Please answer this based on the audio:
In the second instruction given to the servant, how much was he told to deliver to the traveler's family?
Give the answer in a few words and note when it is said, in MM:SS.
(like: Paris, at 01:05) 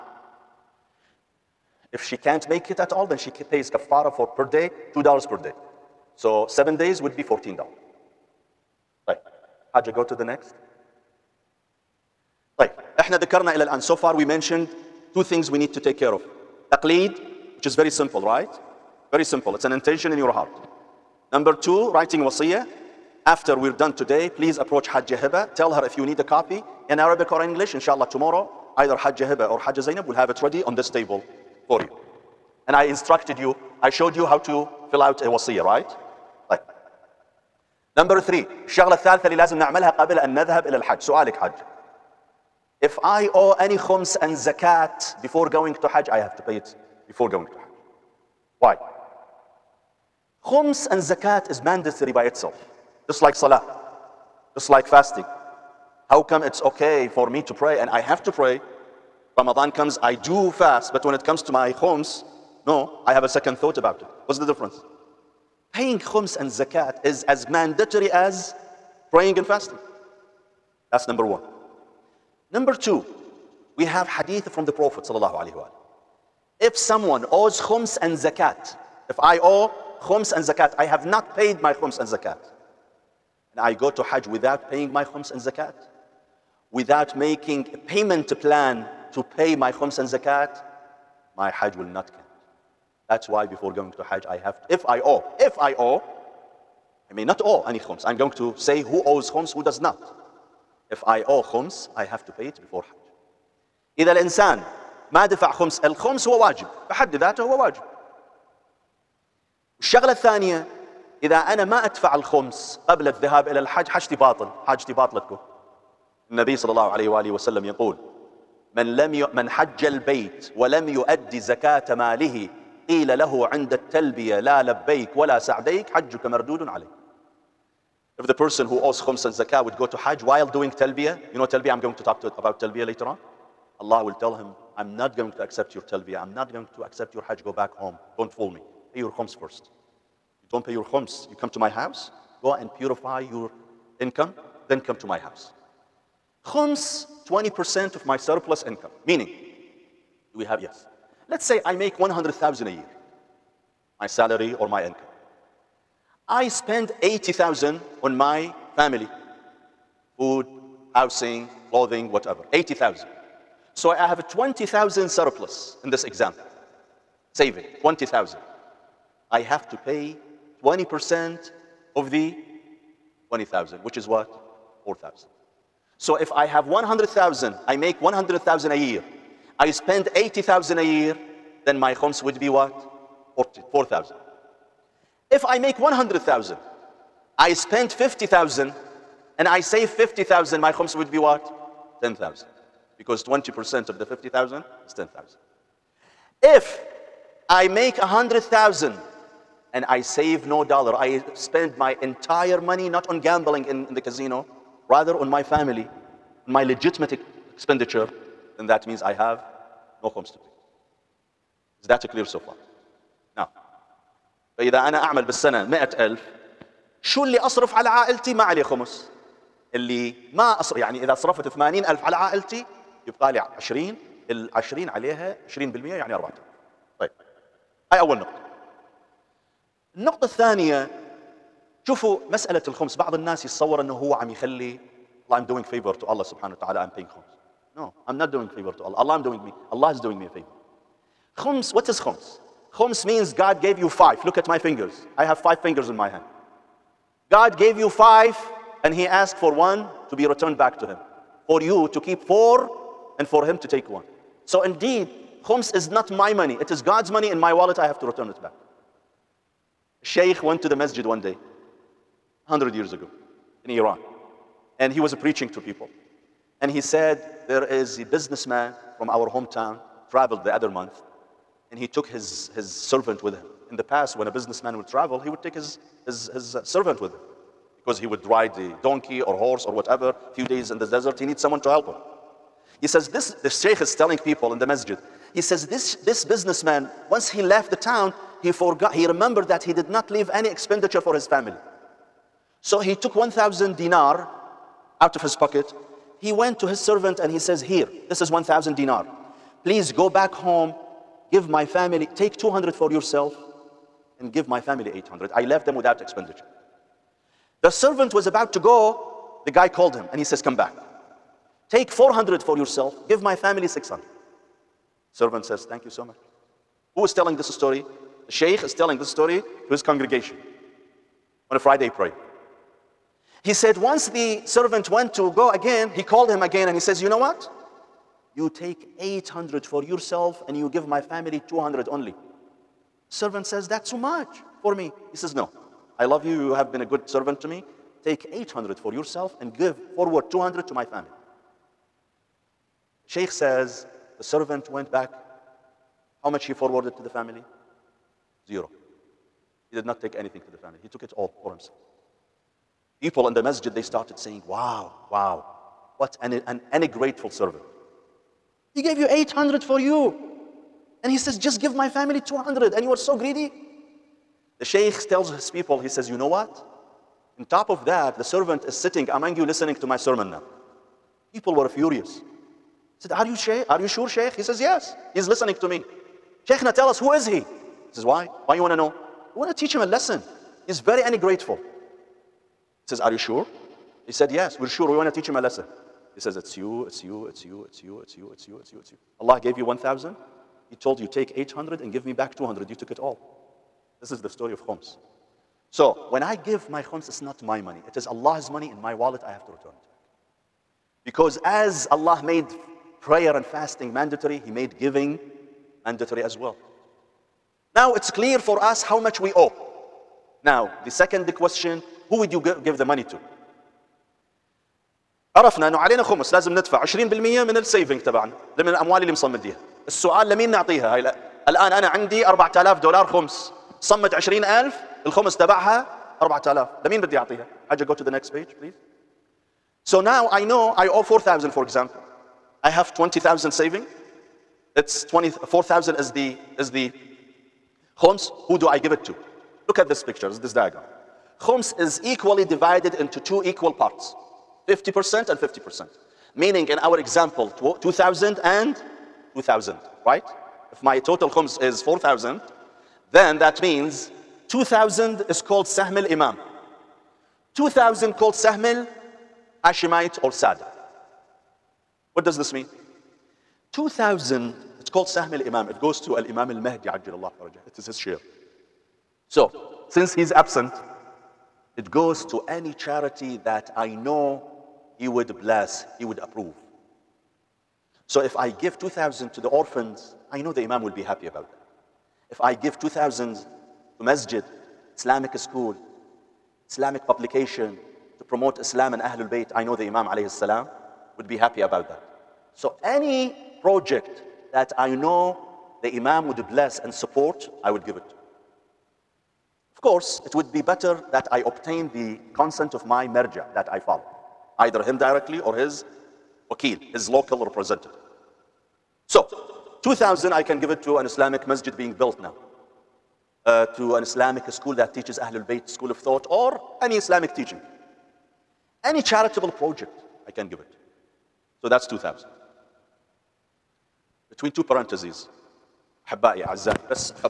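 600, at 05:13.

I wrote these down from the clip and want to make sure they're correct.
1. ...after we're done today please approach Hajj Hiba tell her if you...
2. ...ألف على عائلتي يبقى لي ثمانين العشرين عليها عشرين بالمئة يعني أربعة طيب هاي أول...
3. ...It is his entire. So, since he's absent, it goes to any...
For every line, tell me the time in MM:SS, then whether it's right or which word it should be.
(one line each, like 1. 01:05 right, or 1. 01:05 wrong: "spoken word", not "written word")
1. 00:23 right
2. 03:41 wrong: "عشرين", not "ثمانين"
3. 07:47 wrong: "share", not "entire".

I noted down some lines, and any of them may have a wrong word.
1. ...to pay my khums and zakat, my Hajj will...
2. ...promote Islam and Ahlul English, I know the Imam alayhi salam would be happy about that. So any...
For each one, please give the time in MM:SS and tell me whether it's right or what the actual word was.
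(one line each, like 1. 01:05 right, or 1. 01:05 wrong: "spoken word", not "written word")
1. 01:29 right
2. 08:08 wrong: "Bayt", not "English".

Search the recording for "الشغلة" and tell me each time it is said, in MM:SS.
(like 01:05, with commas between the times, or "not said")
00:38, 01:49.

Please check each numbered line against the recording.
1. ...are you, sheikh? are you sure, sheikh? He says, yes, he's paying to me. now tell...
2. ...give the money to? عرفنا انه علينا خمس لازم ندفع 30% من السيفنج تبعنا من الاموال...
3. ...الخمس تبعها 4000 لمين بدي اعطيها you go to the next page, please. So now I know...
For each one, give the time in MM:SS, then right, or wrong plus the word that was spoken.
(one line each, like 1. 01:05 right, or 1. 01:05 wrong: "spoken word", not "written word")
1. 06:13 wrong: "listening", not "paying"
2. 06:52 wrong: "20", not "30"
3. 07:05 right.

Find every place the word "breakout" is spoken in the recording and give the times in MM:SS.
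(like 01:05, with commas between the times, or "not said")
not said.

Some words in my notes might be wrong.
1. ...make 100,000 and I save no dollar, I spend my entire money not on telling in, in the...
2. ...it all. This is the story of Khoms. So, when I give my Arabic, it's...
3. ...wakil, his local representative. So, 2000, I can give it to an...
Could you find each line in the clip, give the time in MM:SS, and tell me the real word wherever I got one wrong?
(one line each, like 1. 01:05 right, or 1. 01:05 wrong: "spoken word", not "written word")
1. 03:17 wrong: "gambling", not "telling"
2. 06:32 wrong: "Khoms", not "Arabic"
3. 08:26 right.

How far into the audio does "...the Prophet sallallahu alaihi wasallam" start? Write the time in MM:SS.
01:14.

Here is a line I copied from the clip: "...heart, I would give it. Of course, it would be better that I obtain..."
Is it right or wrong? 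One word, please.
wrong.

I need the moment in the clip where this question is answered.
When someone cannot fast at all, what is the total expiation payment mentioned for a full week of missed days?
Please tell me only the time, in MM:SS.
00:07.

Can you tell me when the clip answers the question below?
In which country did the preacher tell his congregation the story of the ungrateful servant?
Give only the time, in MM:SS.
04:23.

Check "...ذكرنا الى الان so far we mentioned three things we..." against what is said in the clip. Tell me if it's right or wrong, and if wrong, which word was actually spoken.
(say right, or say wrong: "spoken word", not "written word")
wrong: "two", not "three".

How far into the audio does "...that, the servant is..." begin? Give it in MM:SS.
06:07.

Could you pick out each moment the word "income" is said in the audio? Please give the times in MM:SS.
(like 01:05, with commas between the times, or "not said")
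02:24, 02:28, 02:34.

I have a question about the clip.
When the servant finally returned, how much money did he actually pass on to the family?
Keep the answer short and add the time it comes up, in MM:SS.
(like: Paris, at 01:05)
Zero, at 05:48.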